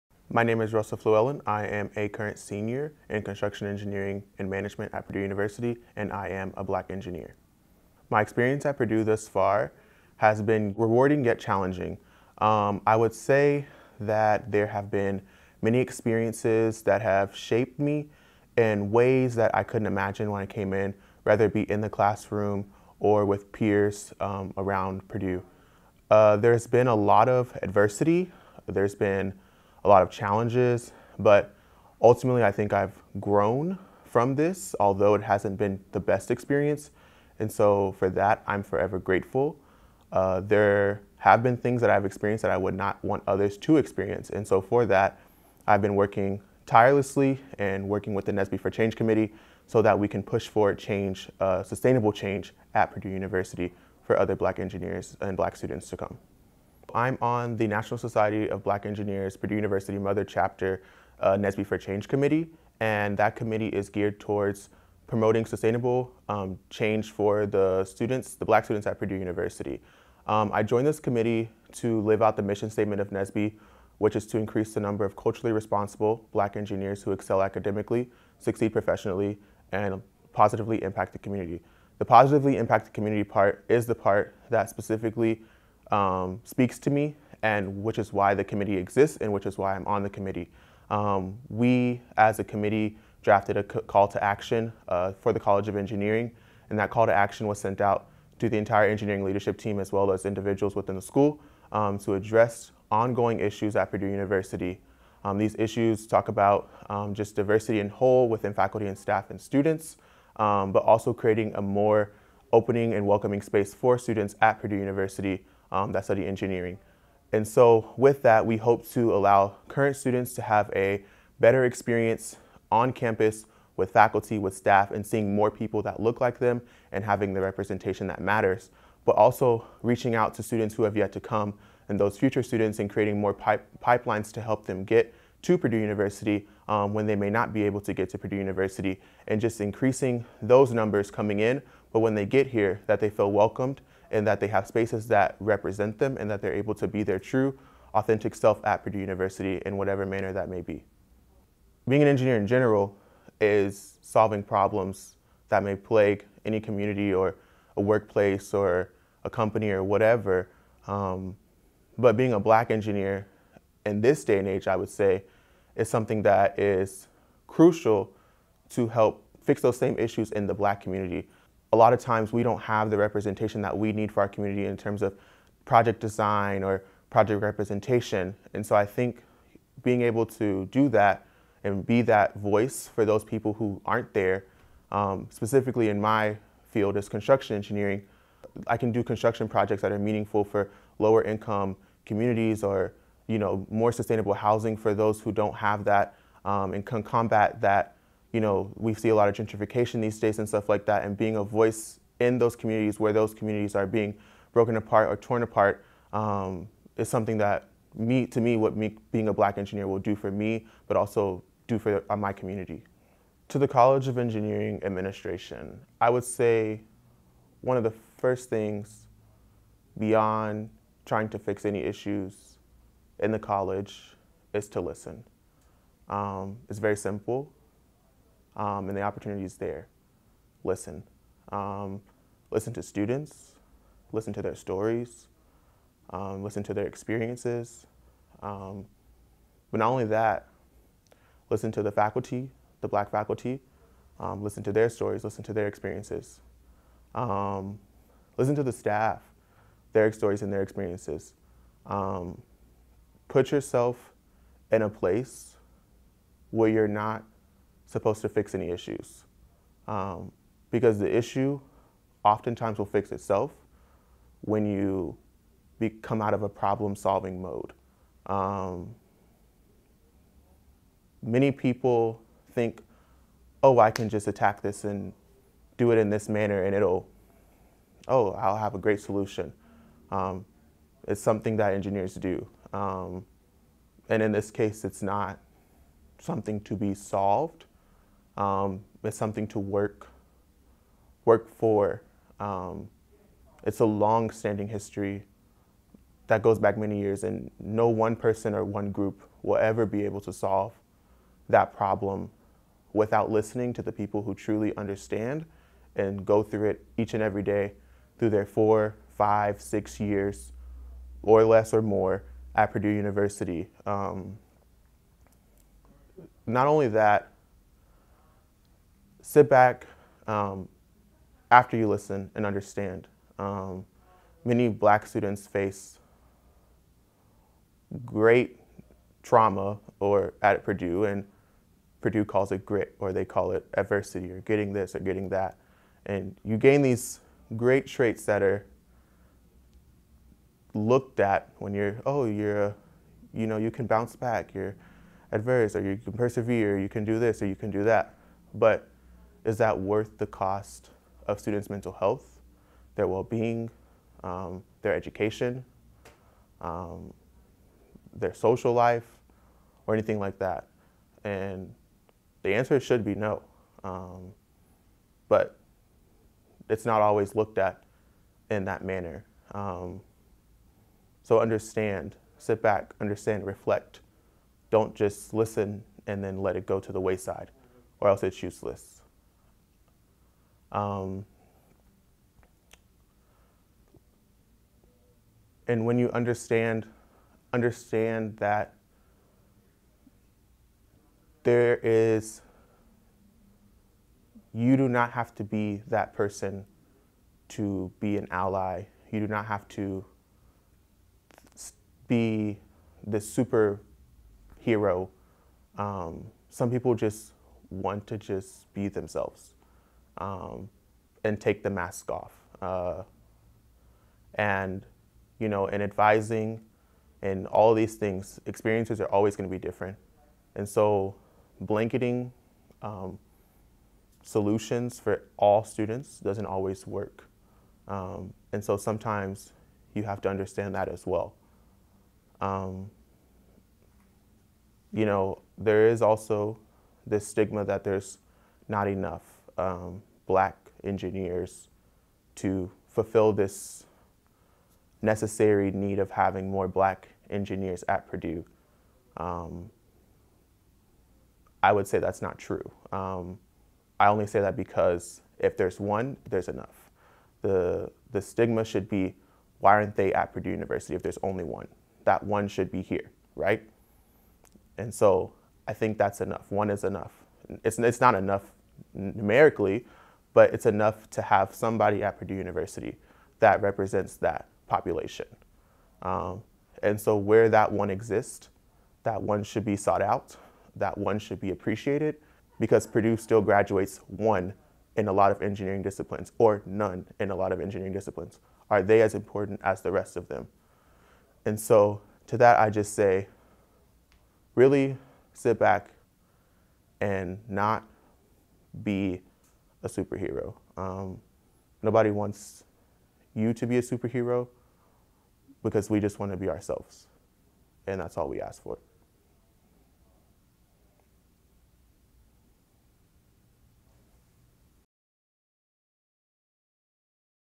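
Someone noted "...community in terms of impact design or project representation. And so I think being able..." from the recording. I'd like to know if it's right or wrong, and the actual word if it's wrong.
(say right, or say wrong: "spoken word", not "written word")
wrong: "project", not "impact".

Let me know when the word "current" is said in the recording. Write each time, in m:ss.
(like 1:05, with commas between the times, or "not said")
0:02, 1:59.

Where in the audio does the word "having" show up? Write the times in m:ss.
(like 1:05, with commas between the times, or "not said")
2:07, 7:26.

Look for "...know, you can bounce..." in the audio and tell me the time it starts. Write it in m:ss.
5:43.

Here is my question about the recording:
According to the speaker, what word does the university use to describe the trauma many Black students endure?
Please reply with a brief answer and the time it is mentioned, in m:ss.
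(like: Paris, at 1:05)
Grit, at 5:32.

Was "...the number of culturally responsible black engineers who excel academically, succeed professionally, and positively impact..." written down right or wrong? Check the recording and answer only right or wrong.
right.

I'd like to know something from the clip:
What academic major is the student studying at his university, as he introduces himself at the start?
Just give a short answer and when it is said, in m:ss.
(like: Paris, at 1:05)
Construction engineering and management, at 0:03.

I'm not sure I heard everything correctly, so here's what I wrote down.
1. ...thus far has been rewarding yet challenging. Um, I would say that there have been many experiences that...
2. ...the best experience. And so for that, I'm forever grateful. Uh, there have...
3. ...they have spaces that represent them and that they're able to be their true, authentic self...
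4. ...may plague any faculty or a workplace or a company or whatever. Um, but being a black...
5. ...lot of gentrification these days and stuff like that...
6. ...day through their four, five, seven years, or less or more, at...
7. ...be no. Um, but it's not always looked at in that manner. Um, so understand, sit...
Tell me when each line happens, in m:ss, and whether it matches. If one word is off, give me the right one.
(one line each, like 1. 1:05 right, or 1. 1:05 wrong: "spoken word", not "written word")
1. 0:09 right
2. 0:35 right
3. 2:24 right
4. 2:35 wrong: "community", not "faculty"
5. 3:19 right
6. 5:07 wrong: "six", not "seven"
7. 6:03 right.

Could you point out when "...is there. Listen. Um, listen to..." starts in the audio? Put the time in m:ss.
3:49.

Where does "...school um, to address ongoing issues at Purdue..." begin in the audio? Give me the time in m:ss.
1:41.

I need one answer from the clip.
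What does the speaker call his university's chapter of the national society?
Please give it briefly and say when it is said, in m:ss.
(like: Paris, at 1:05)
Mother Chapter, at 0:59.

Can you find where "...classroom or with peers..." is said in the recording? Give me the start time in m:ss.
0:21.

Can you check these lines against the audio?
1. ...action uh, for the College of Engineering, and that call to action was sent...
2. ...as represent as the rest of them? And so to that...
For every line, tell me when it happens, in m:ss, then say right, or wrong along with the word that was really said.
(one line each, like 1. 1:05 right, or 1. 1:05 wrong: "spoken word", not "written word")
1. 1:34 right
2. 8:09 wrong: "important", not "represent".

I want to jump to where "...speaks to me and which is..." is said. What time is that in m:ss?
1:26.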